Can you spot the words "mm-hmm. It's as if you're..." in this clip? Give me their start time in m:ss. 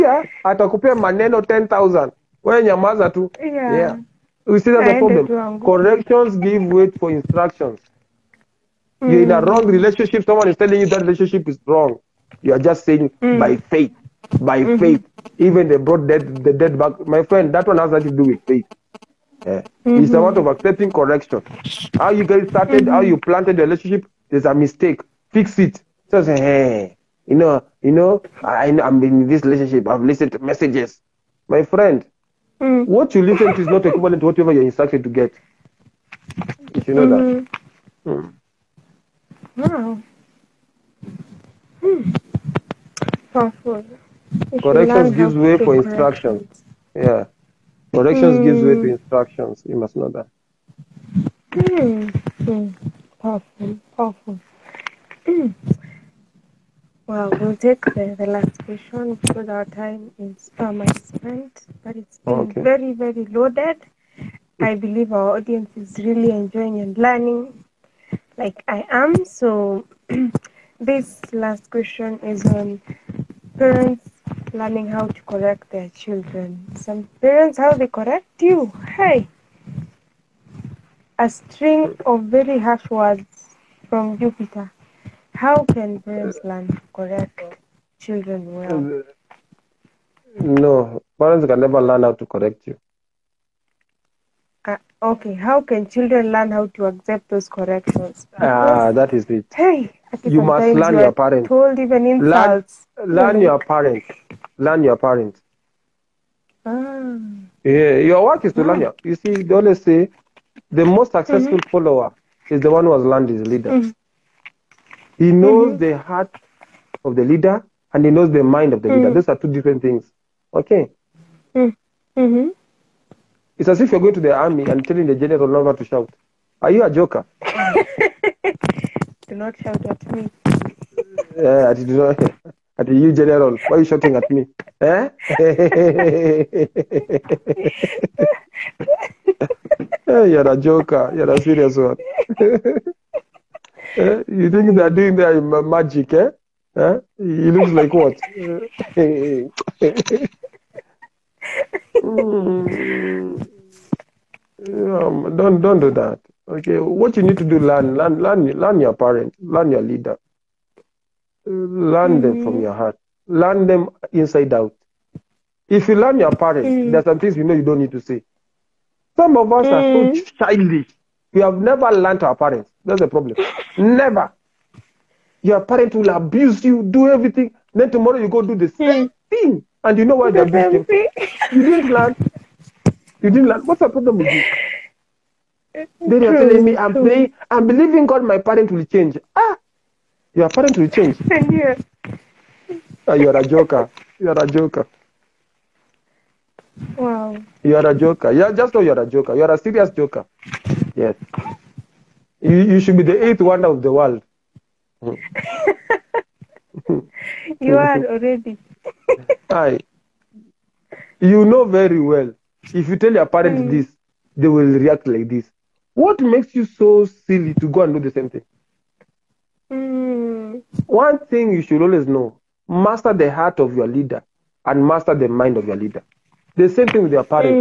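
2:02.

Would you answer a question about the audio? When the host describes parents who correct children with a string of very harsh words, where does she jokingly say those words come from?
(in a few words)
Jupiter.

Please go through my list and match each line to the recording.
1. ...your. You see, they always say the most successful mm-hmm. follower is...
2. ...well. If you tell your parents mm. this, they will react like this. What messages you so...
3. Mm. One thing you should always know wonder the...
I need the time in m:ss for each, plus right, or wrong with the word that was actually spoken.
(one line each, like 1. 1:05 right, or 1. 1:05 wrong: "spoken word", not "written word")
1. 1:48 right
2. 3:32 wrong: "makes", not "messages"
3. 3:39 wrong: "master", not "wonder".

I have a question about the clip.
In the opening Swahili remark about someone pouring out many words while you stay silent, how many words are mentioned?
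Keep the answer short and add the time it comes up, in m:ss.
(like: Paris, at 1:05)
10,000, at 0:01.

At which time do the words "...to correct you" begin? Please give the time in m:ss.
1:32.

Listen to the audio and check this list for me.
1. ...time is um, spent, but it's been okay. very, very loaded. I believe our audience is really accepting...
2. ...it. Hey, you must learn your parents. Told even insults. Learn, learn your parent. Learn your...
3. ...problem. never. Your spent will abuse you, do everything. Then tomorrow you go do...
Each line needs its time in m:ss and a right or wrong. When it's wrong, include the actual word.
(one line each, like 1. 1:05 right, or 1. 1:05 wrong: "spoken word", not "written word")
1. 0:59 wrong: "enjoying", not "accepting"
2. 1:39 right
3. 2:53 wrong: "parent", not "spent".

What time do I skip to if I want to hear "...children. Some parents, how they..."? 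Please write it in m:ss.
1:16.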